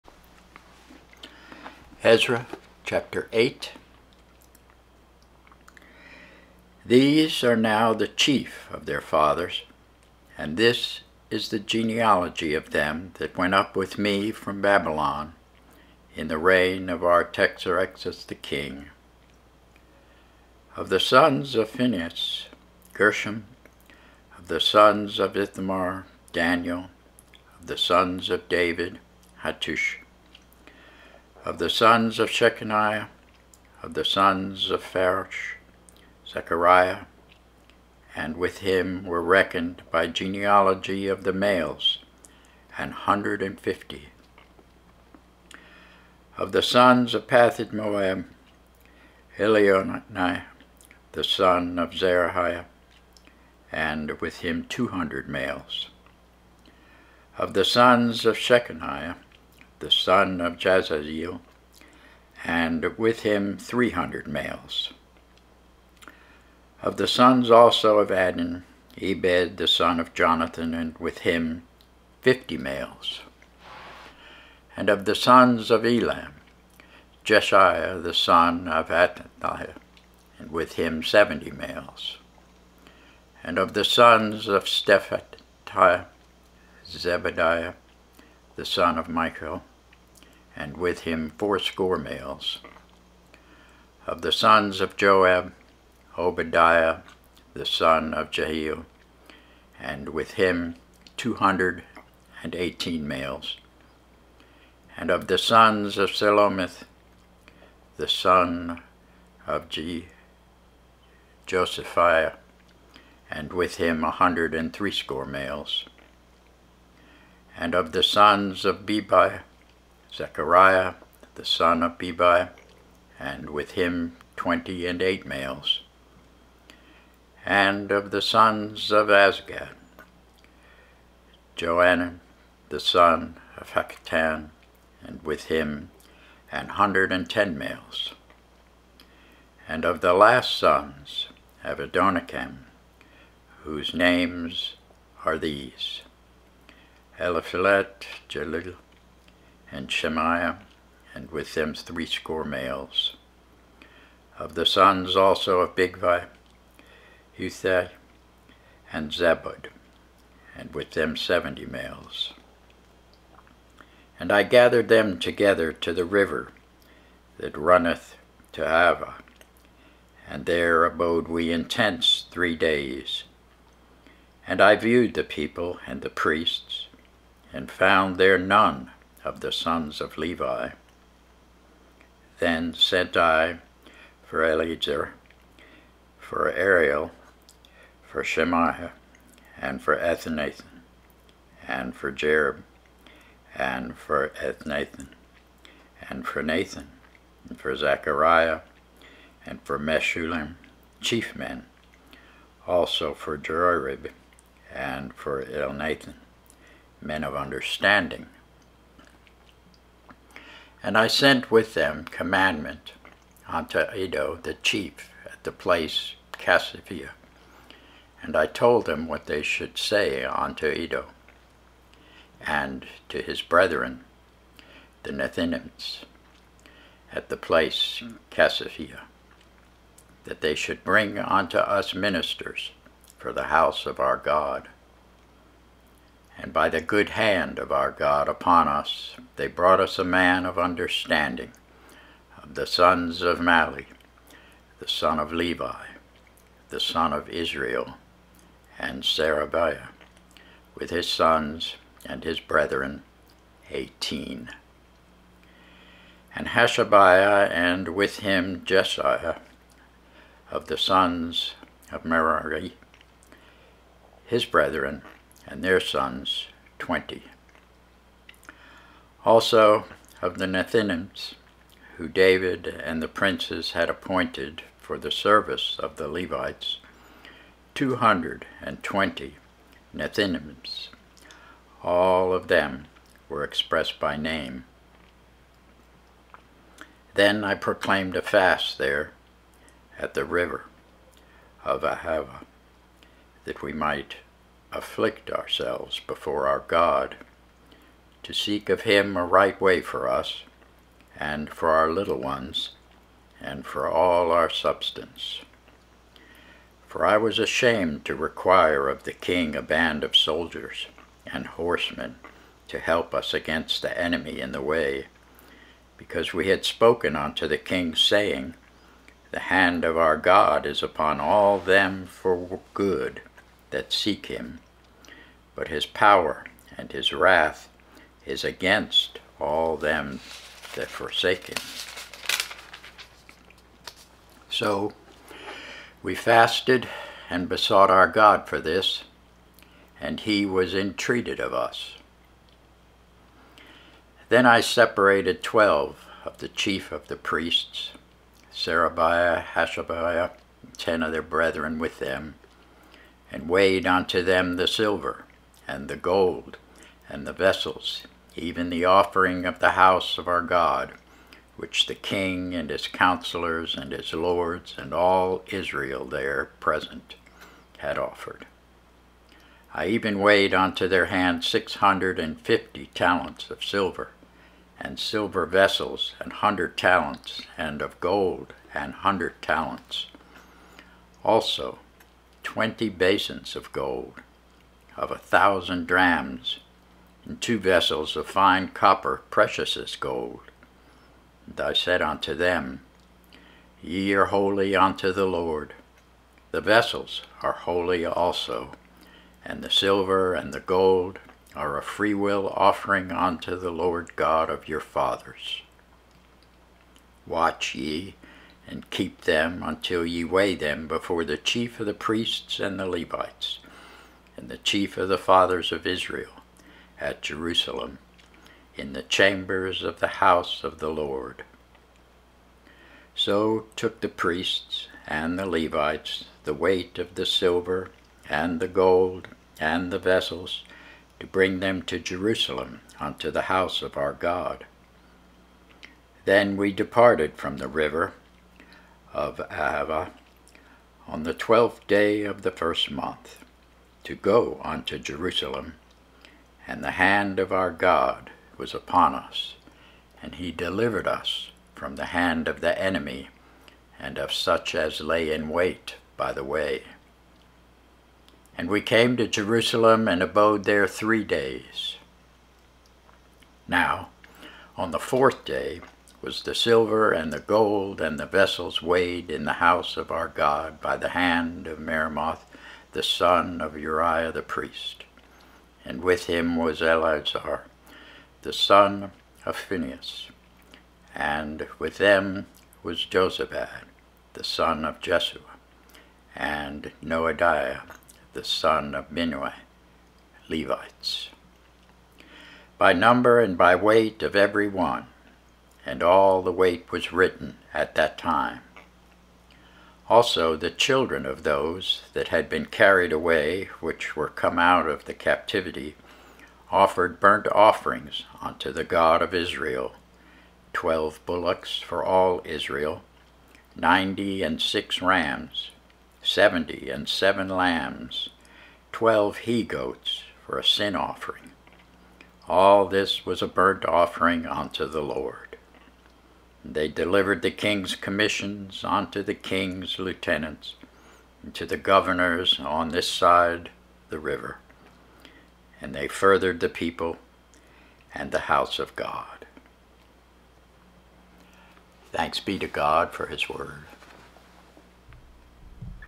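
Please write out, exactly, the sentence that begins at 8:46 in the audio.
They delivered the king's commissions unto the king's lieutenants and to the governors on this side the river.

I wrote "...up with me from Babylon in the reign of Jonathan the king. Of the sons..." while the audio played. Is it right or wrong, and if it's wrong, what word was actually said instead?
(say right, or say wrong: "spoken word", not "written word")
wrong: "Artaxerxes", not "Jonathan".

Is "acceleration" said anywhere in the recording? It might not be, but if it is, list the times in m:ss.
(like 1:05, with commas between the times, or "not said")
not said.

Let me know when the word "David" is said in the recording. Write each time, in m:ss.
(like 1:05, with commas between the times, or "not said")
0:28, 4:32.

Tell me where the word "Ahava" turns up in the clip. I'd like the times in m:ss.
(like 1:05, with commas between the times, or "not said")
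2:48, 4:51, 7:19.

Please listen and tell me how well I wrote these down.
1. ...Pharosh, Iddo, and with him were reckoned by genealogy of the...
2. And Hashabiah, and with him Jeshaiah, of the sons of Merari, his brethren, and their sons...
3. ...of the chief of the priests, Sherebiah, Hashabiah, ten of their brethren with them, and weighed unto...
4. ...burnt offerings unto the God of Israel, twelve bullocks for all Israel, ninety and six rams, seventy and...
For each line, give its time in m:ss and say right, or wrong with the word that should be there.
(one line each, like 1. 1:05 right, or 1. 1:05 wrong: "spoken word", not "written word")
1. 0:34 wrong: "Zechariah", not "Iddo"
2. 4:16 right
3. 5:46 right
4. 8:27 right.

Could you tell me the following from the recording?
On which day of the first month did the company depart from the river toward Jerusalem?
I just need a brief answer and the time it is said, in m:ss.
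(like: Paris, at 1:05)
The twelfth, at 7:21.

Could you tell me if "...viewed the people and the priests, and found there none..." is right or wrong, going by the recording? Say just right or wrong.
right.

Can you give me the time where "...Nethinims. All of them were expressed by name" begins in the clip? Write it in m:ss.
4:39.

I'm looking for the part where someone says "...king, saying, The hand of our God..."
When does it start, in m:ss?
5:17.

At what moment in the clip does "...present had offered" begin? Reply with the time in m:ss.
6:06.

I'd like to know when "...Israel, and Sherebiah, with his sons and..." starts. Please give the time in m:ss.
4:07.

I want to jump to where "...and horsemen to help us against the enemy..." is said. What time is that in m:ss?
5:11.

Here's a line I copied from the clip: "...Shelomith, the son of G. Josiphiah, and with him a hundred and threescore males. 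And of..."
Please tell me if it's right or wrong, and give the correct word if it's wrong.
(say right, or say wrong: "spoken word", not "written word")
right.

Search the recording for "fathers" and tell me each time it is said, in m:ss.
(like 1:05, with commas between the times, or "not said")
0:09, 6:44, 6:55.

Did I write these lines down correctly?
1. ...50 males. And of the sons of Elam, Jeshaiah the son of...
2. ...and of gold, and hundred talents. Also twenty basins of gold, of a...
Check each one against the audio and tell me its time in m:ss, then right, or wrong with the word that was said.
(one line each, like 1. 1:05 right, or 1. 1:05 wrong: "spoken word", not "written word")
1. 1:12 right
2. 6:17 right.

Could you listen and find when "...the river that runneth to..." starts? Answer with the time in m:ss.
2:45.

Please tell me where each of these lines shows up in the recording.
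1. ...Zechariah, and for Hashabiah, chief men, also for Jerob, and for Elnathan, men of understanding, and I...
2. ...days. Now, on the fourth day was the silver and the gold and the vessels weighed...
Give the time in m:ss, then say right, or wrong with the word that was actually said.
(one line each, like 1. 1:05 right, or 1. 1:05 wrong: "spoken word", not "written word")
1. 3:17 wrong: "Meshullam", not "Hashabiah"
2. 7:41 right.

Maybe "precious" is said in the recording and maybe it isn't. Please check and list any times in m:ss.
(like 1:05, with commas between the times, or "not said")
6:29.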